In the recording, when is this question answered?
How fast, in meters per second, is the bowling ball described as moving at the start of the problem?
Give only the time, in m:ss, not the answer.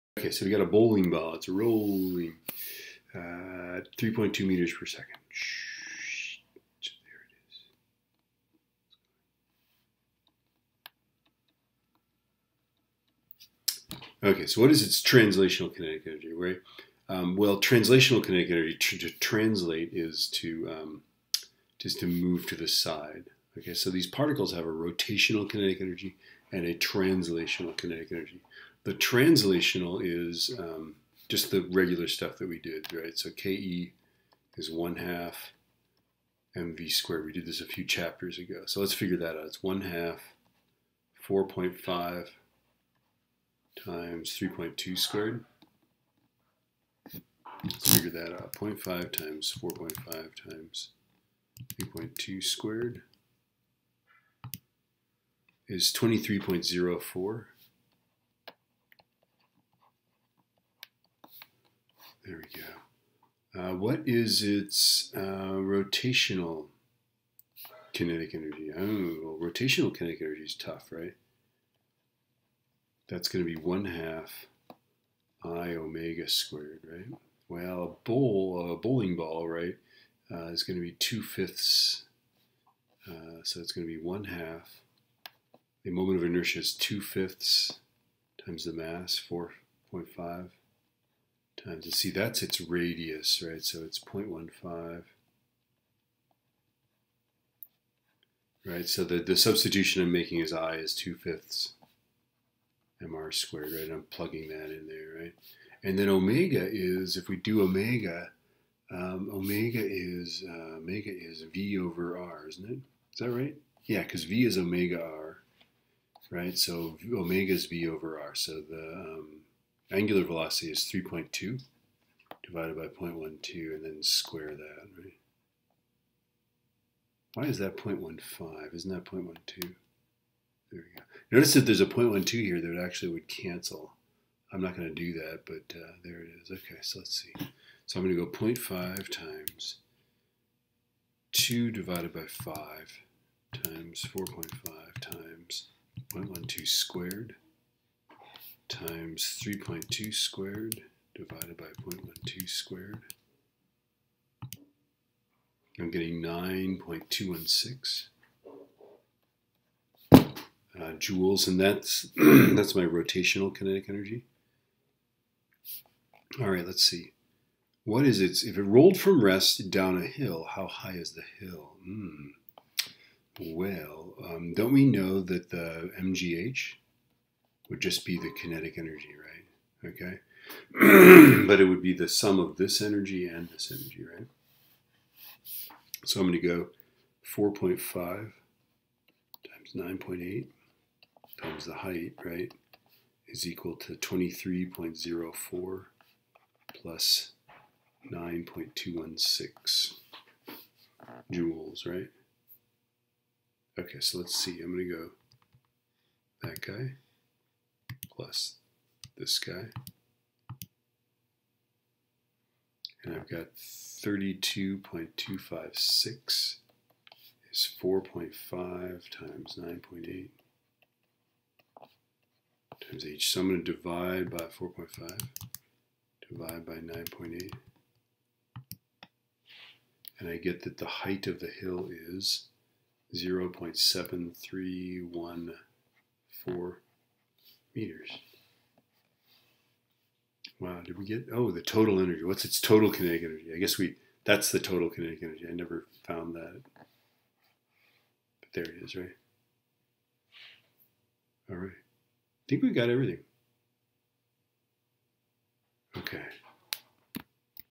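0:03.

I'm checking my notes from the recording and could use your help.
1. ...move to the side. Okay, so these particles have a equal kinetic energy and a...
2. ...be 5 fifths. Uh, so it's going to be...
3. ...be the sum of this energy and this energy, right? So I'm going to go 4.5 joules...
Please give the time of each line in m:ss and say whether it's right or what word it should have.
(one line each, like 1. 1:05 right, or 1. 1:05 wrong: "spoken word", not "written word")
1. 0:22 wrong: "rotational", not "equal"
2. 1:20 wrong: "2", not "5"
3. 3:01 wrong: "times", not "joules".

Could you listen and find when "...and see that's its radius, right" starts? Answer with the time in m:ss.
1:31.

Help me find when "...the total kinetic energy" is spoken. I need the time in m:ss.
4:04.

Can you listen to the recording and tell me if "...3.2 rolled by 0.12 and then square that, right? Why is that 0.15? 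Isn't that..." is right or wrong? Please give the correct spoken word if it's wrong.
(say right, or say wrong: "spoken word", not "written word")
wrong: "divided", not "rolled".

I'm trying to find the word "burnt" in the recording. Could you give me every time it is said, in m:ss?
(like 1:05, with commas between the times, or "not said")
not said.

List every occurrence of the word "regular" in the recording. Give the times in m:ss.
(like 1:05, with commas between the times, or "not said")
0:31.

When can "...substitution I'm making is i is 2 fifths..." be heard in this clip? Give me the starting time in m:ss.
1:39.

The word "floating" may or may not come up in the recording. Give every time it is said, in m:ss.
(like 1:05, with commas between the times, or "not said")
not said.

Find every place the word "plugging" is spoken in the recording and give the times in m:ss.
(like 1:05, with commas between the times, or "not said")
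1:44.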